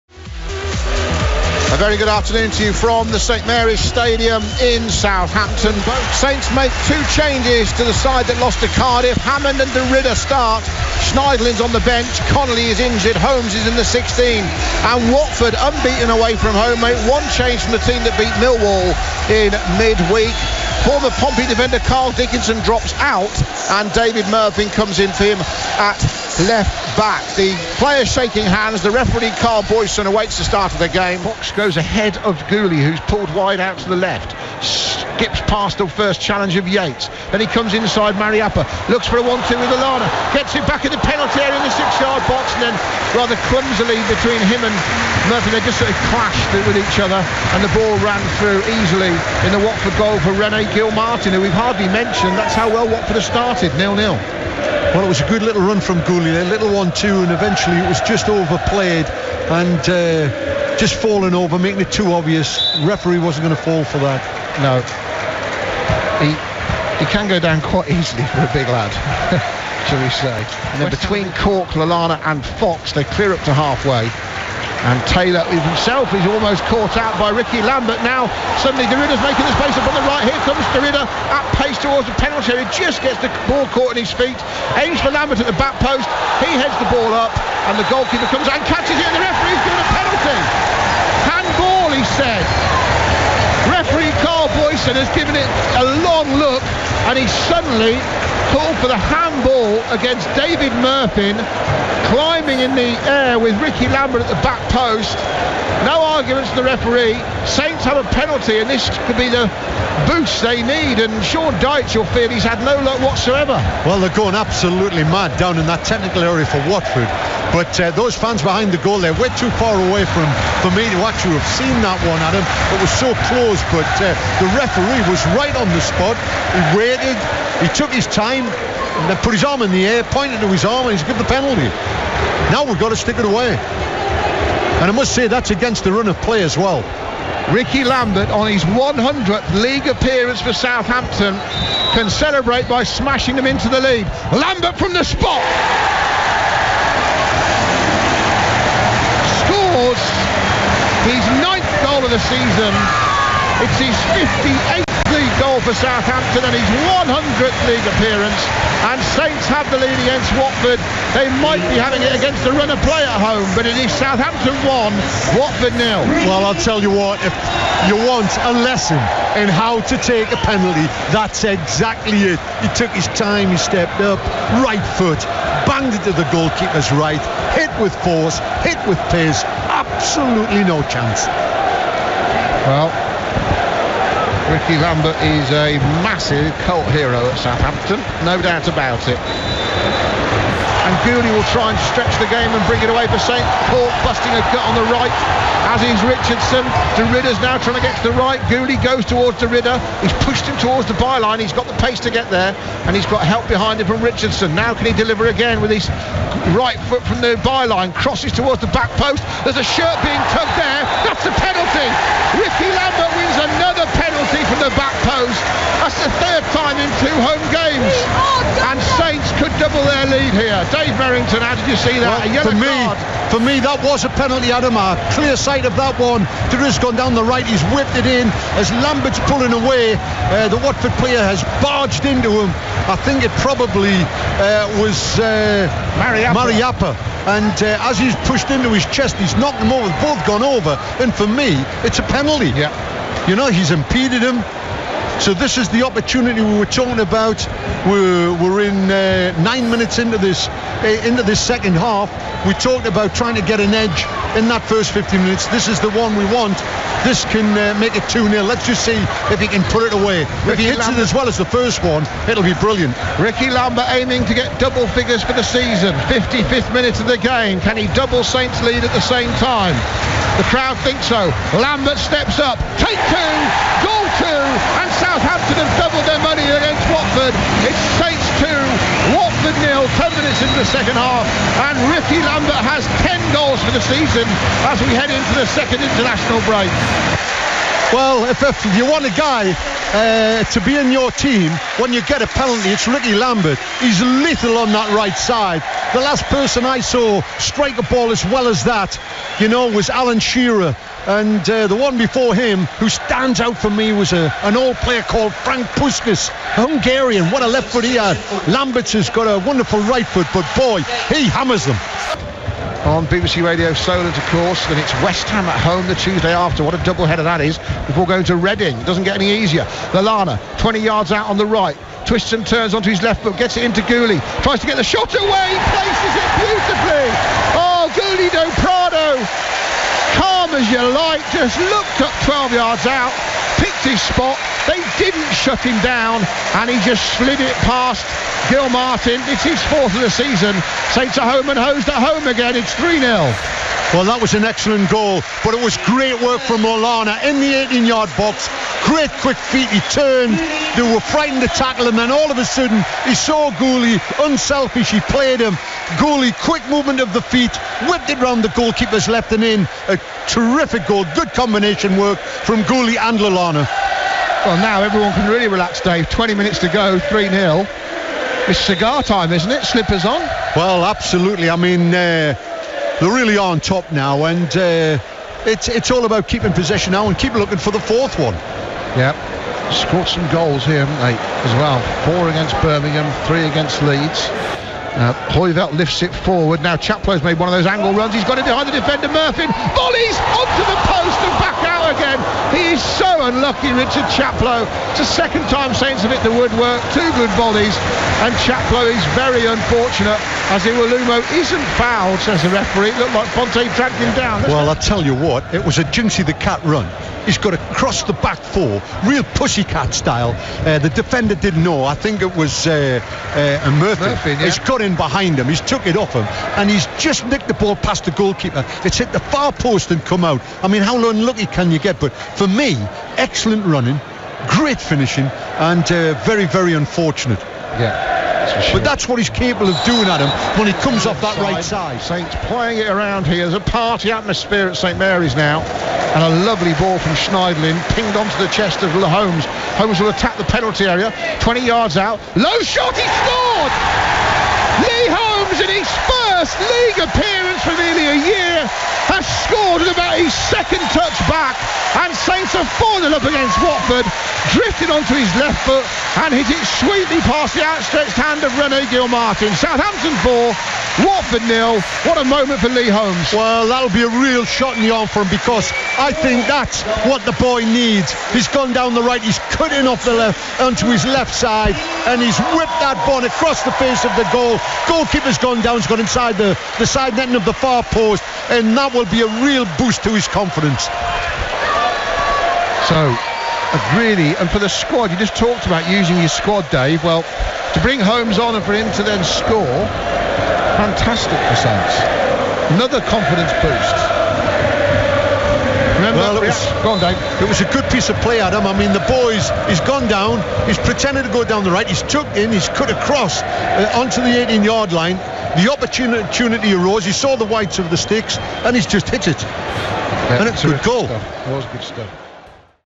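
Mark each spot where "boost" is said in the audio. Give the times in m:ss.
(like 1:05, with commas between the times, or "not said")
1:50, 7:59, 8:13.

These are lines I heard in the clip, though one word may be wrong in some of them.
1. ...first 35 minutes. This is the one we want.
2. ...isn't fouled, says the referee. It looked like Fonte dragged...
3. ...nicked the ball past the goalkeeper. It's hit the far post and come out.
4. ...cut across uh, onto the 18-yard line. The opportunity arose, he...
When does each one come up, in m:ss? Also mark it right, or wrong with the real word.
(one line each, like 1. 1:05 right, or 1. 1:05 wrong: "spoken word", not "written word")
1. 4:14 wrong: "15", not "35"
2. 6:41 right
3. 6:57 right
4. 8:22 right.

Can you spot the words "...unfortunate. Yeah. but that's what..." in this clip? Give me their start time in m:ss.
7:06.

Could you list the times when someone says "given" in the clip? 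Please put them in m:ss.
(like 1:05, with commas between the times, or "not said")
1:29, 1:35, 2:11.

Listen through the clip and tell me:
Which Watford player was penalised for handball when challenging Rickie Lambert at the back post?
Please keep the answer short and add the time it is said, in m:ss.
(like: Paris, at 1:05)
David Murphy, at 1:40.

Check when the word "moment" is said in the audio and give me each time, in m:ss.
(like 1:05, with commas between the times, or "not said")
7:42.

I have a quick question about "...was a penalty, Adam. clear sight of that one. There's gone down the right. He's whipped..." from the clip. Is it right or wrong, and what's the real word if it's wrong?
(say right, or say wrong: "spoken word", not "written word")
right.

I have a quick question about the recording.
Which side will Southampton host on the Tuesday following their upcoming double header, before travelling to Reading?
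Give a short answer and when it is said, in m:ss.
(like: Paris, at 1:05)
West Ham, at 5:15.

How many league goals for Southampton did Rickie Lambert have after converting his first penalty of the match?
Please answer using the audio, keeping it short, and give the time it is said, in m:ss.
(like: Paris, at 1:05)
58, at 2:34.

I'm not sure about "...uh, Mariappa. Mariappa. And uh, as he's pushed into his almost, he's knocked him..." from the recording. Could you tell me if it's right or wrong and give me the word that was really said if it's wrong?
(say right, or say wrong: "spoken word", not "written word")
wrong: "chest", not "almost".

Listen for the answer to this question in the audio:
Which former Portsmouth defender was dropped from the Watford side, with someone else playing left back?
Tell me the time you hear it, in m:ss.
0:21.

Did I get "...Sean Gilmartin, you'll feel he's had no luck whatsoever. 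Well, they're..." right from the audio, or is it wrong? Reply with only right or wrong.
wrong.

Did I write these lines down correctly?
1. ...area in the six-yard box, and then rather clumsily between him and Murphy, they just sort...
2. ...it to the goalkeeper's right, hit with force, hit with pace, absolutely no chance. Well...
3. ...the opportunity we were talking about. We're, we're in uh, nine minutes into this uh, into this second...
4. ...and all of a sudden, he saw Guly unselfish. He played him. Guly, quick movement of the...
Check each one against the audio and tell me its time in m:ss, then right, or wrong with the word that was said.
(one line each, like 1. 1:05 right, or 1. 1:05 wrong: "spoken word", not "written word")
1. 0:41 right
2. 2:55 right
3. 4:05 right
4. 5:51 right.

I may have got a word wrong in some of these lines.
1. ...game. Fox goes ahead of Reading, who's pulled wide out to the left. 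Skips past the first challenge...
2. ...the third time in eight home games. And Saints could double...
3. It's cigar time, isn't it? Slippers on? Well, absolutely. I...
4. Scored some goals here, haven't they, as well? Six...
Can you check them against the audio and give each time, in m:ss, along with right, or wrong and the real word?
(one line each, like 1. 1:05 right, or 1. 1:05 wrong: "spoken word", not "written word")
1. 0:30 wrong: "Guly", not "Reading"
2. 3:36 wrong: "two", not "eight"
3. 6:08 right
4. 6:19 wrong: "Four", not "Six".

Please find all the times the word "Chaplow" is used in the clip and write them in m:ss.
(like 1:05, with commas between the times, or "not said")
6:26, 6:34, 6:38.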